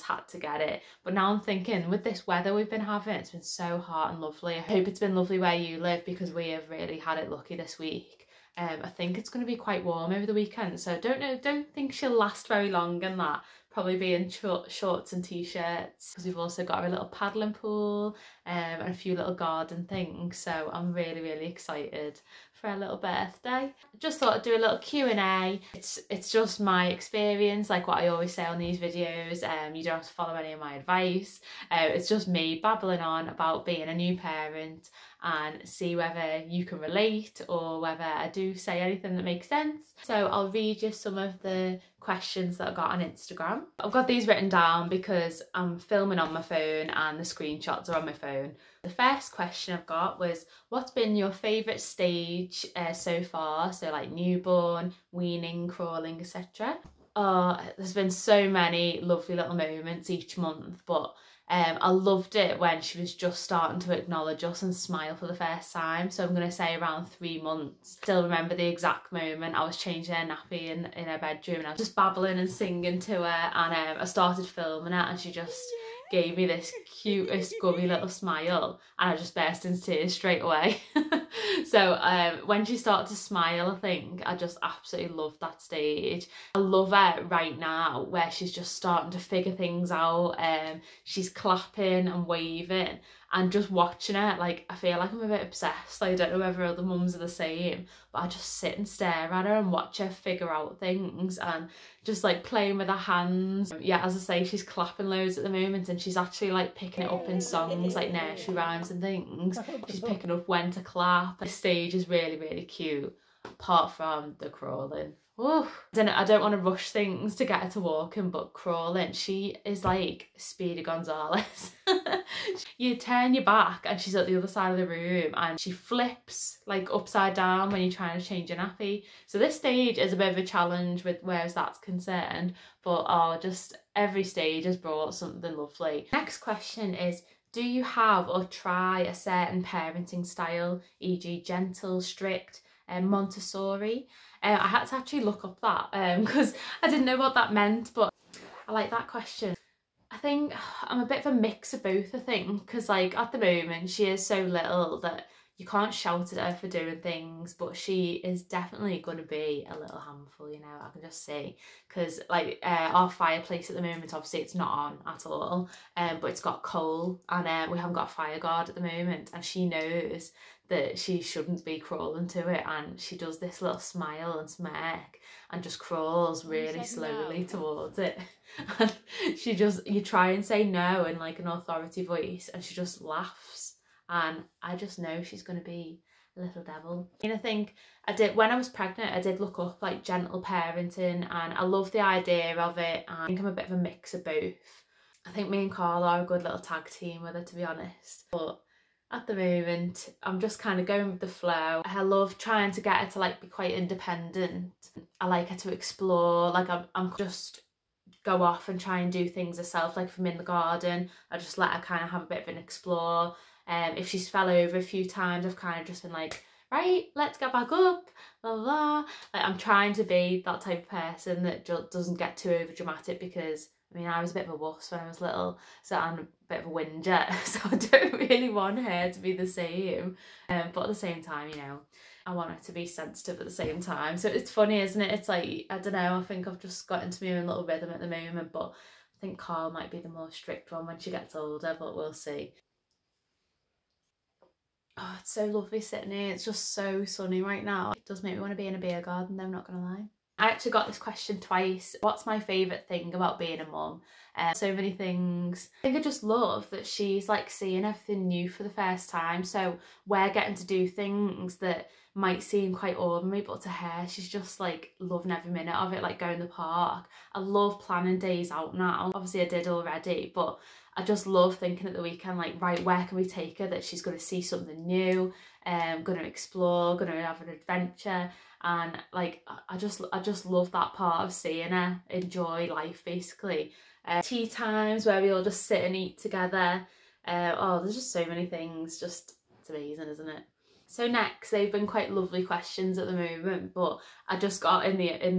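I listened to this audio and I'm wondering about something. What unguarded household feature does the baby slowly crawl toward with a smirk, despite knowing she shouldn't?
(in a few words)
fireplace.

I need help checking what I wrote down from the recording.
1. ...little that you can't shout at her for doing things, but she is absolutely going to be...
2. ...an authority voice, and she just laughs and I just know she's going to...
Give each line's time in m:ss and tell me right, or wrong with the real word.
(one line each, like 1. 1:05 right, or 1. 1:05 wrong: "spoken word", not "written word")
1. 2:34 wrong: "definitely", not "absolutely"
2. 3:01 right.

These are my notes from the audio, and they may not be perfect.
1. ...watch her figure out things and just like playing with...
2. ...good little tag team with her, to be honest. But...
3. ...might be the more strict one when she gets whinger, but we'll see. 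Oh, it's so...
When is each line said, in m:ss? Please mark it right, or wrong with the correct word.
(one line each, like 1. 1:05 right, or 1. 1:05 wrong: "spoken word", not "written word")
1. 1:39 right
2. 3:16 right
3. 3:59 wrong: "older", not "whinger".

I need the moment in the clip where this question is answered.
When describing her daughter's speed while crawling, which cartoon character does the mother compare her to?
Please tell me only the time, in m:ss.
2:00.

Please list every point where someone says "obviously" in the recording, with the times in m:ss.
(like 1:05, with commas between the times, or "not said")
2:44, 4:29.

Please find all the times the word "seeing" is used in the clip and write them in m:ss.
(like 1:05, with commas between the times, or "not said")
4:17, 4:41.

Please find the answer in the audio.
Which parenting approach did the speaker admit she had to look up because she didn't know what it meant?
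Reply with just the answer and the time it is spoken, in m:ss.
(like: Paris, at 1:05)
Montessori, at 2:23.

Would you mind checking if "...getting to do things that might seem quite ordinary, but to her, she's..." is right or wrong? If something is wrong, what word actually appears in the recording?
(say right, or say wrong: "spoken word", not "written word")
right.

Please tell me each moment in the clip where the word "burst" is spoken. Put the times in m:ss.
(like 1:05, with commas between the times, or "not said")
1:19.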